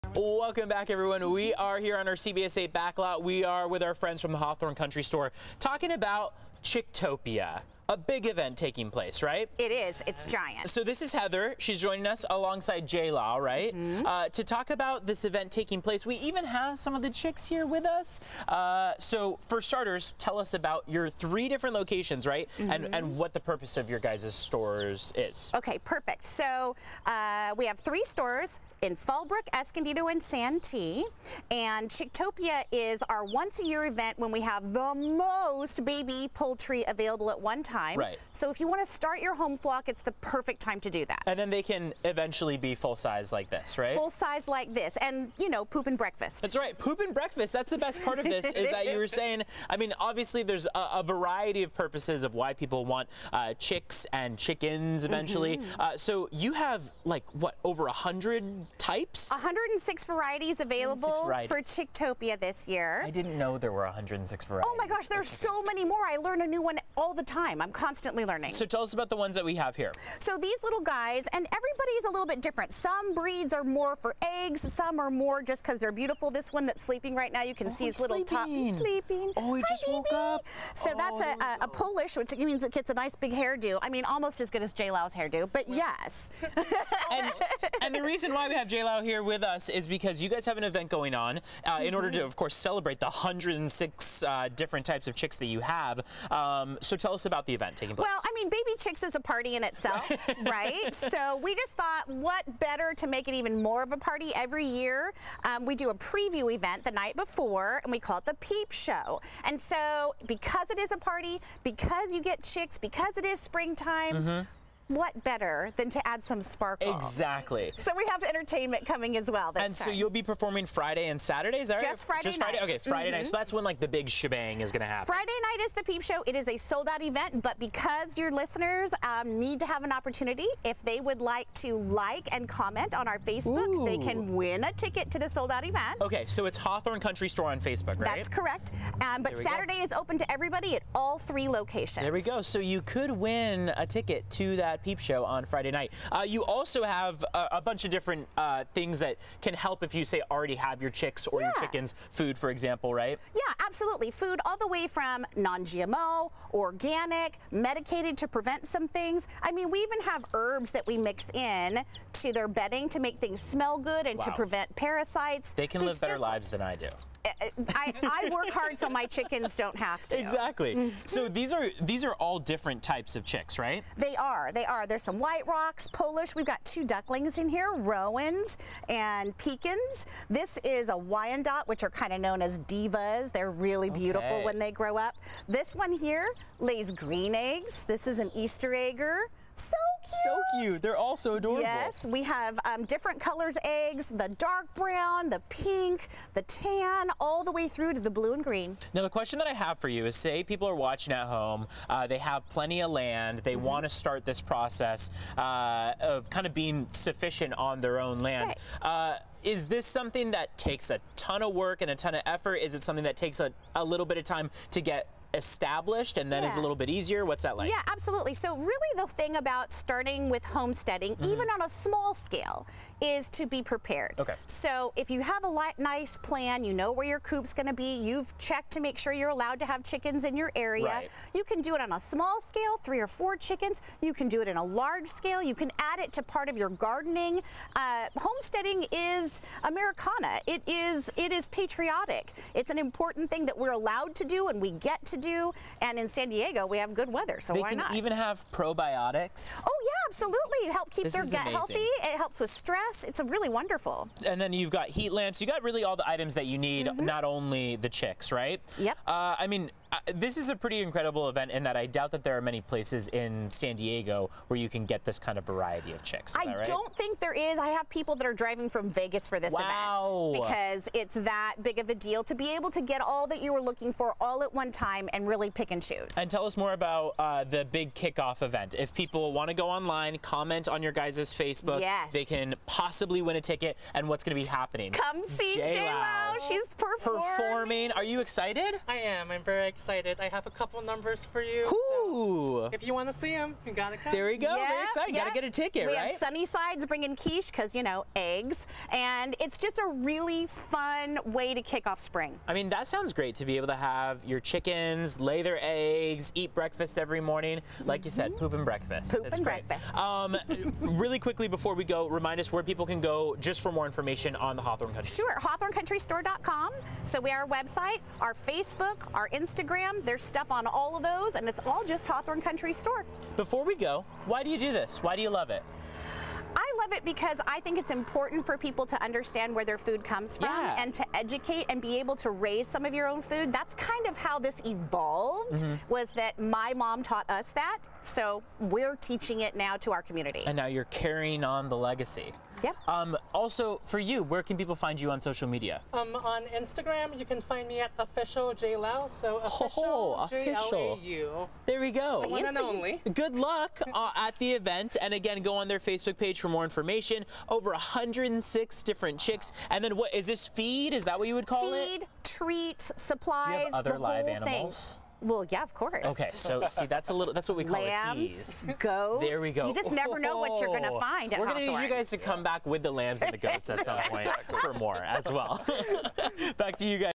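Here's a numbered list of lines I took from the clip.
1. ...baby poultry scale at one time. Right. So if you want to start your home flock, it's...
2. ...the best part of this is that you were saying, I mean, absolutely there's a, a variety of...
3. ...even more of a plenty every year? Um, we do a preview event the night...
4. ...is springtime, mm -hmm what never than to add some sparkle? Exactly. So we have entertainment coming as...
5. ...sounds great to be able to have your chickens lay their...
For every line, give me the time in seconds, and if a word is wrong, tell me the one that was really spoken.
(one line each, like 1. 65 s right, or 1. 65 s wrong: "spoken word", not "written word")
1. 35 s wrong: "available", not "scale"
2. 47 s wrong: "obviously", not "absolutely"
3. 103 s wrong: "party", not "plenty"
4. 113 s wrong: "better", not "never"
5. 302 s right.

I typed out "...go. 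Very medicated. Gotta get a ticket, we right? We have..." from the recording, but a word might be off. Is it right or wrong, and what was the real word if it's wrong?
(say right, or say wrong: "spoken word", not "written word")
wrong: "excited", not "medicated".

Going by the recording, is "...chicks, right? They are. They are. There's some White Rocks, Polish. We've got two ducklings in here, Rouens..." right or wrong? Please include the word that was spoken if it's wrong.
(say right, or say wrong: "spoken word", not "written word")
right.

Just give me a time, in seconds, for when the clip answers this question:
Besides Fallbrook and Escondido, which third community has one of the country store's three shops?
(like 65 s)
30 s.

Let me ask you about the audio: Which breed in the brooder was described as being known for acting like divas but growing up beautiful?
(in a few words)
Wyandotte.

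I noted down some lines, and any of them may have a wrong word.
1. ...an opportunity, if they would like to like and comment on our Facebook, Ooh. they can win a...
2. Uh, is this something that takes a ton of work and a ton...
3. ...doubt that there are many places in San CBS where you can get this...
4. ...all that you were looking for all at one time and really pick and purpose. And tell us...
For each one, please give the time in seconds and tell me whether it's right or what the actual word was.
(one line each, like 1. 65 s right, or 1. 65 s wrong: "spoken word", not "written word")
1. 129 s right
2. 209 s right
3. 261 s wrong: "Diego", not "CBS"
4. 273 s wrong: "choose", not "purpose".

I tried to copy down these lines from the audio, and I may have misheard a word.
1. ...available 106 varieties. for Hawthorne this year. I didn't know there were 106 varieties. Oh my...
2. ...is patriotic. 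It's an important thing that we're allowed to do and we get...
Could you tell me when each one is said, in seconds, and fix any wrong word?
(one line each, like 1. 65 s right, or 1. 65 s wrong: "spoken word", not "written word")
1. 60 s wrong: "Chicktopia", not "Hawthorne"
2. 241 s right.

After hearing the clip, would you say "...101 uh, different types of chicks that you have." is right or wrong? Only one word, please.
wrong.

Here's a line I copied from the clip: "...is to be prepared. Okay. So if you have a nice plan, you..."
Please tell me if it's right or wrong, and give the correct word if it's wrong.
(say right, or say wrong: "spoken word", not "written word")
right.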